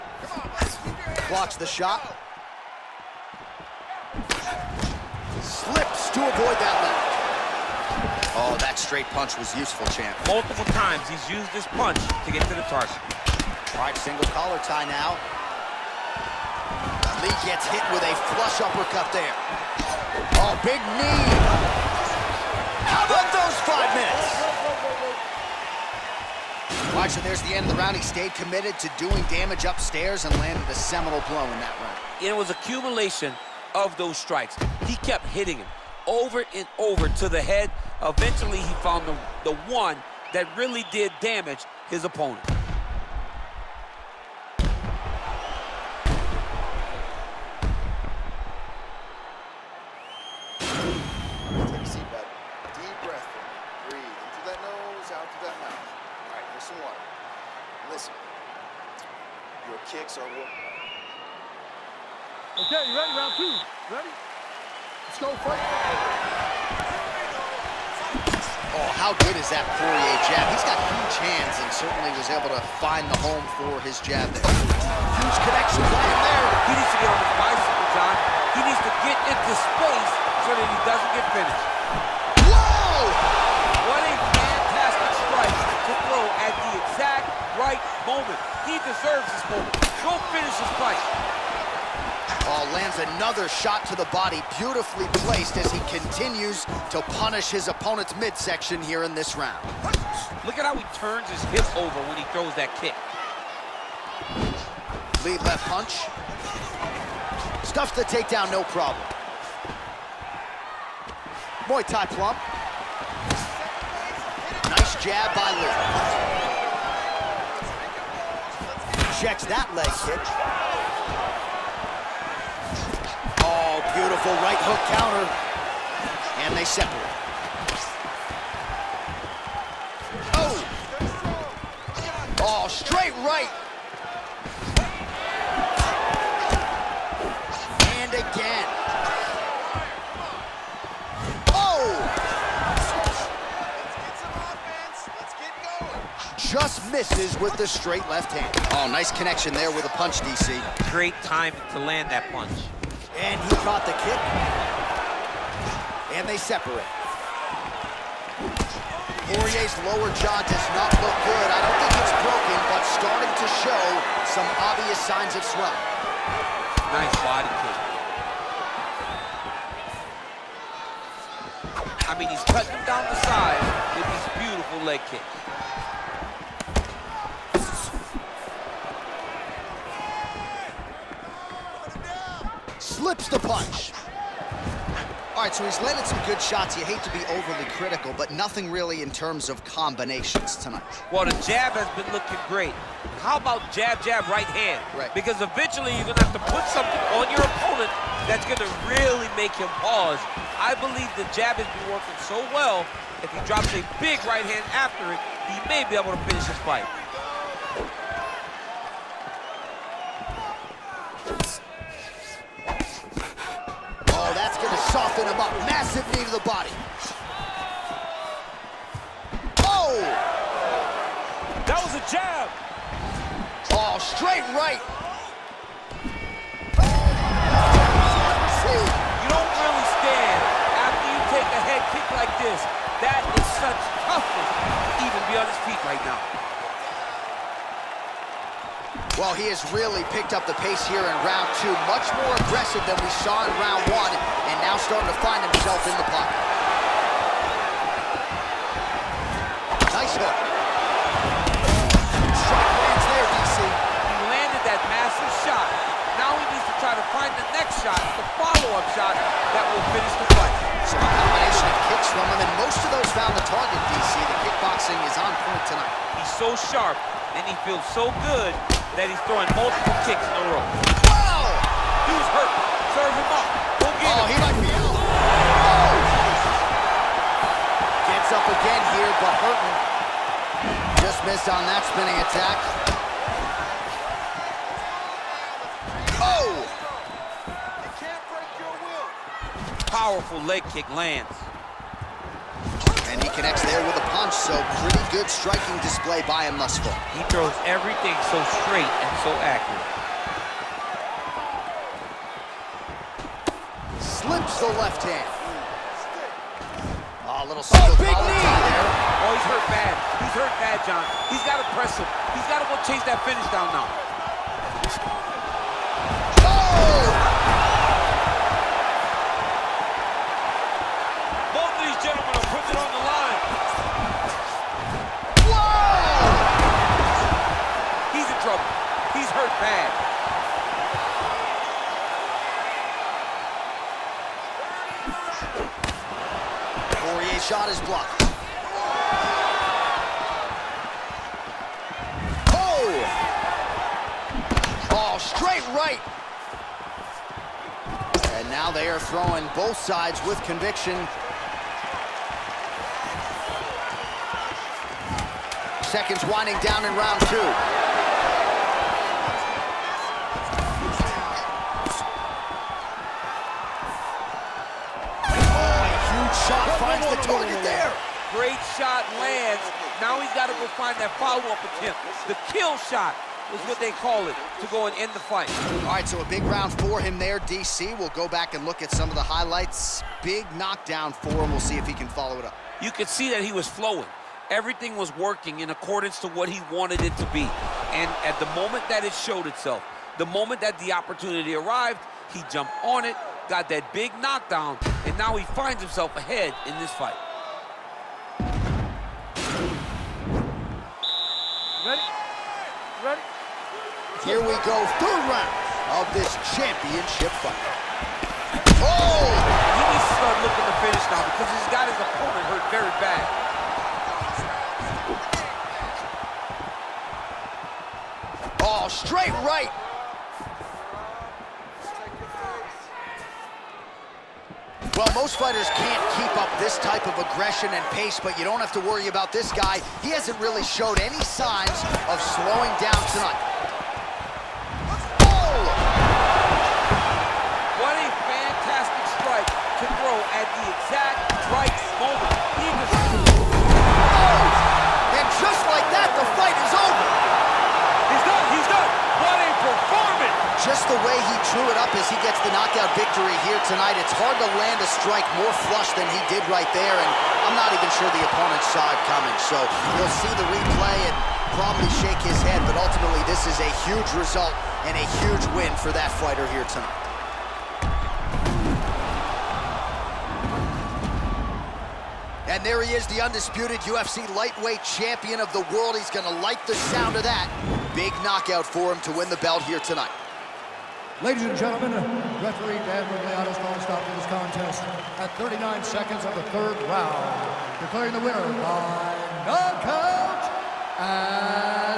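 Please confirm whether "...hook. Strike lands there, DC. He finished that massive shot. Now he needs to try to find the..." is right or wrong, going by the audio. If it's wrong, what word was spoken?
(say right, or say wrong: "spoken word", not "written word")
wrong: "landed", not "finished".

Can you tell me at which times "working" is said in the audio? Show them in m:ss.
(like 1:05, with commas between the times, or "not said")
3:21, 6:25.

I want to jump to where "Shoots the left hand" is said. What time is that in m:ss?
5:04.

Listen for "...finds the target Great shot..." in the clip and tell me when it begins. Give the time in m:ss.
6:06.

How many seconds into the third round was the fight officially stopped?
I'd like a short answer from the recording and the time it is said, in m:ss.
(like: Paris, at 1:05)
39, at 8:05.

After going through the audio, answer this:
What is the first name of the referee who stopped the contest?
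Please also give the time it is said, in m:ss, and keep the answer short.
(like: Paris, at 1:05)
Dan, at 8:02.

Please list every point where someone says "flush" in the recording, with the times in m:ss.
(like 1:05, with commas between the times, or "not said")
0:18, 7:35.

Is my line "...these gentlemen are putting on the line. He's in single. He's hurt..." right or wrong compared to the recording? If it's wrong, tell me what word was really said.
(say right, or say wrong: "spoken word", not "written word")
wrong: "trouble", not "single".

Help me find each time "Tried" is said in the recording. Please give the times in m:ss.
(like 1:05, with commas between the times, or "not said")
0:13.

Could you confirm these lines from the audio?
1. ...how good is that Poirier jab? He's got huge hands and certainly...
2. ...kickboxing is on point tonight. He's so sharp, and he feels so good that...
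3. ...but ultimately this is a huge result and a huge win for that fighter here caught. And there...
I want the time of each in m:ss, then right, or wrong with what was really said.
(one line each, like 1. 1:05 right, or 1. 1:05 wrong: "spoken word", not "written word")
1. 1:08 right
2. 4:24 right
3. 7:42 wrong: "tonight", not "caught".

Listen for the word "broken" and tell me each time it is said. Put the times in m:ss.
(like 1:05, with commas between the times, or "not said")
2:42.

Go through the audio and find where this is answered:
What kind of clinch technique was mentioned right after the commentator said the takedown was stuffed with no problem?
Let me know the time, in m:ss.
1:51.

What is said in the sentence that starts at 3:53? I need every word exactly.
That is such toughness even be on his feet right now.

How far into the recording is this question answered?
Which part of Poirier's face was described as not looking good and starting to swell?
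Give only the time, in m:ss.
2:39.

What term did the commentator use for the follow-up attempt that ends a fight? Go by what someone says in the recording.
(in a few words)
The kill shot.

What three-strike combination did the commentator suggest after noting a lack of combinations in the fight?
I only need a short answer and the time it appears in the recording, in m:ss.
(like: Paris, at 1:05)
jab, jab, right hand, at 3:13.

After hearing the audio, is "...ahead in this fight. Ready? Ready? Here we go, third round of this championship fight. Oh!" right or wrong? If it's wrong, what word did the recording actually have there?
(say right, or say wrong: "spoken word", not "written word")
right.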